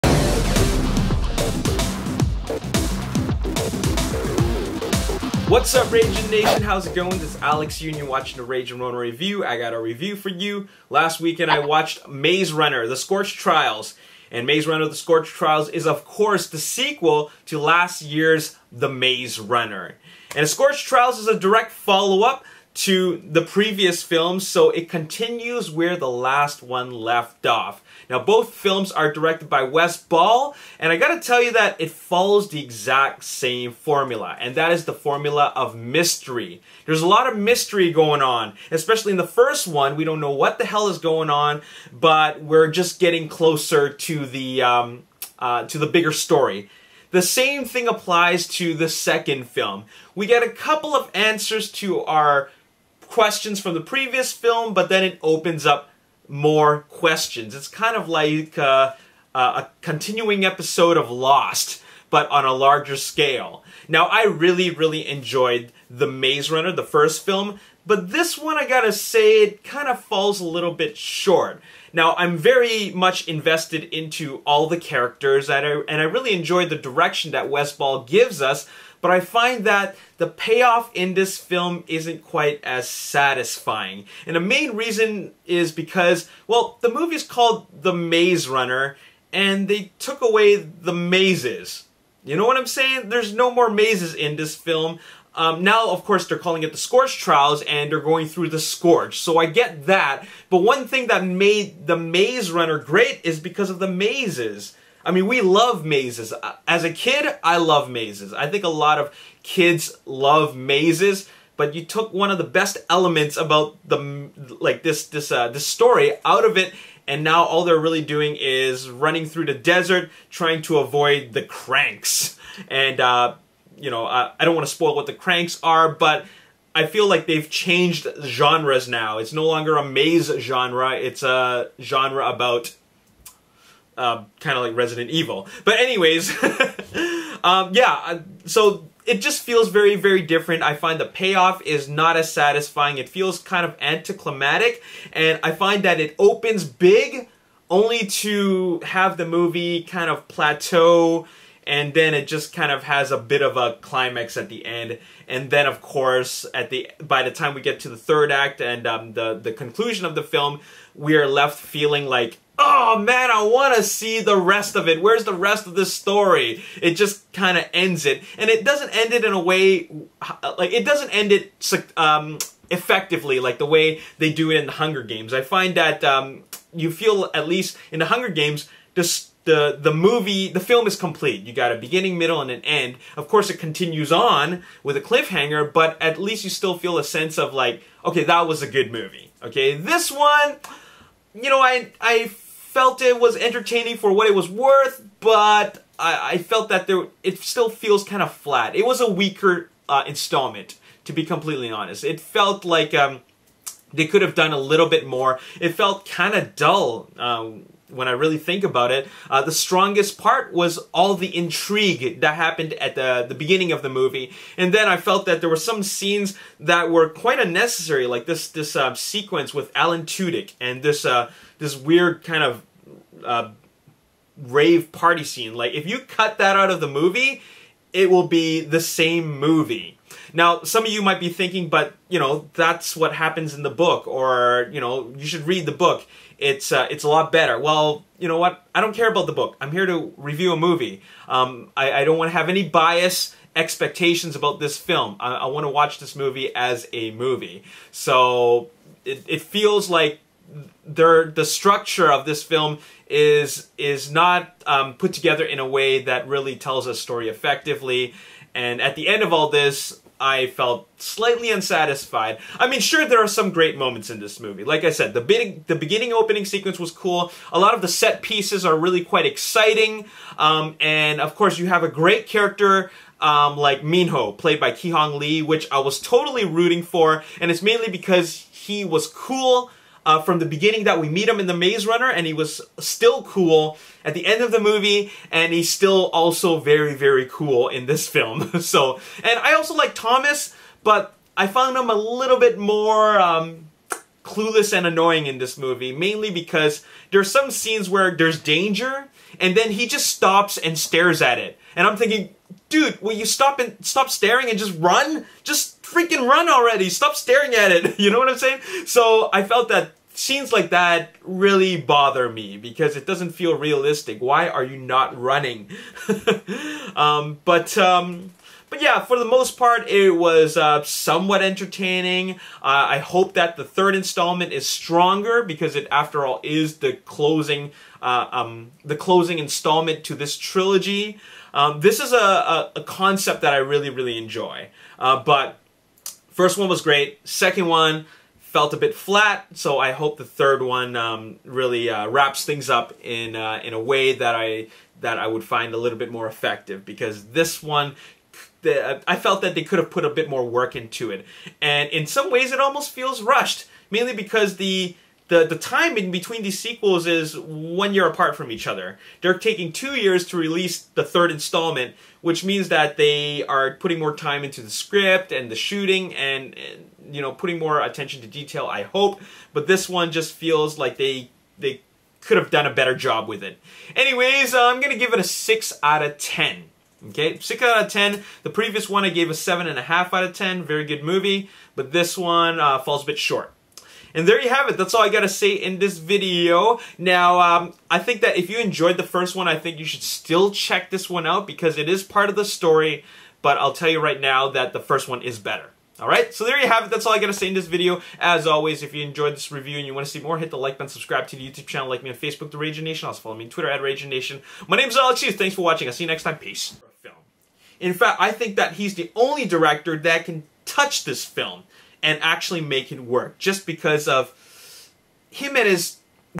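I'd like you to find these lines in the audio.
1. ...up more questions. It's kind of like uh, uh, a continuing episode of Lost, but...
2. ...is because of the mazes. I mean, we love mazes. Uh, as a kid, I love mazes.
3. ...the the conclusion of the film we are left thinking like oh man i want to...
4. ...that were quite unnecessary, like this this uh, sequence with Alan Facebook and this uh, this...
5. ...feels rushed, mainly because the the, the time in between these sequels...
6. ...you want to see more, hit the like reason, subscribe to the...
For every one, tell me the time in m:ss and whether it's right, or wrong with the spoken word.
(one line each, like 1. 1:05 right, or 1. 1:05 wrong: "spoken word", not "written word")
1. 0:55 right
2. 1:43 right
3. 2:39 wrong: "feeling", not "thinking"
4. 3:36 wrong: "Tudyk", not "Facebook"
5. 5:52 right
6. 6:39 wrong: "button", not "reason".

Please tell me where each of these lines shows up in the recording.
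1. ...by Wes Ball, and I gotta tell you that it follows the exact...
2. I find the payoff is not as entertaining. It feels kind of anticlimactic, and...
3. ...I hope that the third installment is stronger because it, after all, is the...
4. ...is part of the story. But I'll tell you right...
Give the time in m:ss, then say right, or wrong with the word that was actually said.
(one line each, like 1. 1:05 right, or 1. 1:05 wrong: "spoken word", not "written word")
1. 0:29 right
2. 2:20 wrong: "satisfying", not "entertaining"
3. 5:22 right
4. 6:31 right.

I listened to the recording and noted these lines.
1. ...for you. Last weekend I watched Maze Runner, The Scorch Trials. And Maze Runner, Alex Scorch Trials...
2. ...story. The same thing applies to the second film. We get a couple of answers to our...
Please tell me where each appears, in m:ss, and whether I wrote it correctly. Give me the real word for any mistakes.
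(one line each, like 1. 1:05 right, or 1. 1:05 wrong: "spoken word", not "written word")
1. 0:10 wrong: "The", not "Alex"
2. 0:46 right.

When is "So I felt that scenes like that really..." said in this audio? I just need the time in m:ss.
5:08.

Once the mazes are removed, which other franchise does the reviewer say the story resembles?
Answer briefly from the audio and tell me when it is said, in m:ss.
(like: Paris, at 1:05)
Resident Evil, at 2:14.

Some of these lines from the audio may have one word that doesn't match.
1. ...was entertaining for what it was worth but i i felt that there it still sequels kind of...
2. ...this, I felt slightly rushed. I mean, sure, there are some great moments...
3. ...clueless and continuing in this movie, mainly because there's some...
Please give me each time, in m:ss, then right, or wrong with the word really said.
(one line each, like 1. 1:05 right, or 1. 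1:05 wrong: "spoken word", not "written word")
1. 3:13 wrong: "feels", not "sequels"
2. 4:19 wrong: "unsatisfied", not "rushed"
3. 4:54 wrong: "annoying", not "continuing".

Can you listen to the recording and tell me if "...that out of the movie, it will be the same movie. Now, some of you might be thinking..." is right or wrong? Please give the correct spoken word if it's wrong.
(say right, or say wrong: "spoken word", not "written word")
right.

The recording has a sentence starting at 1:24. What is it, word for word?
And the main reason is because, well, the movie's called The Maze Runner, and they took away the mazes.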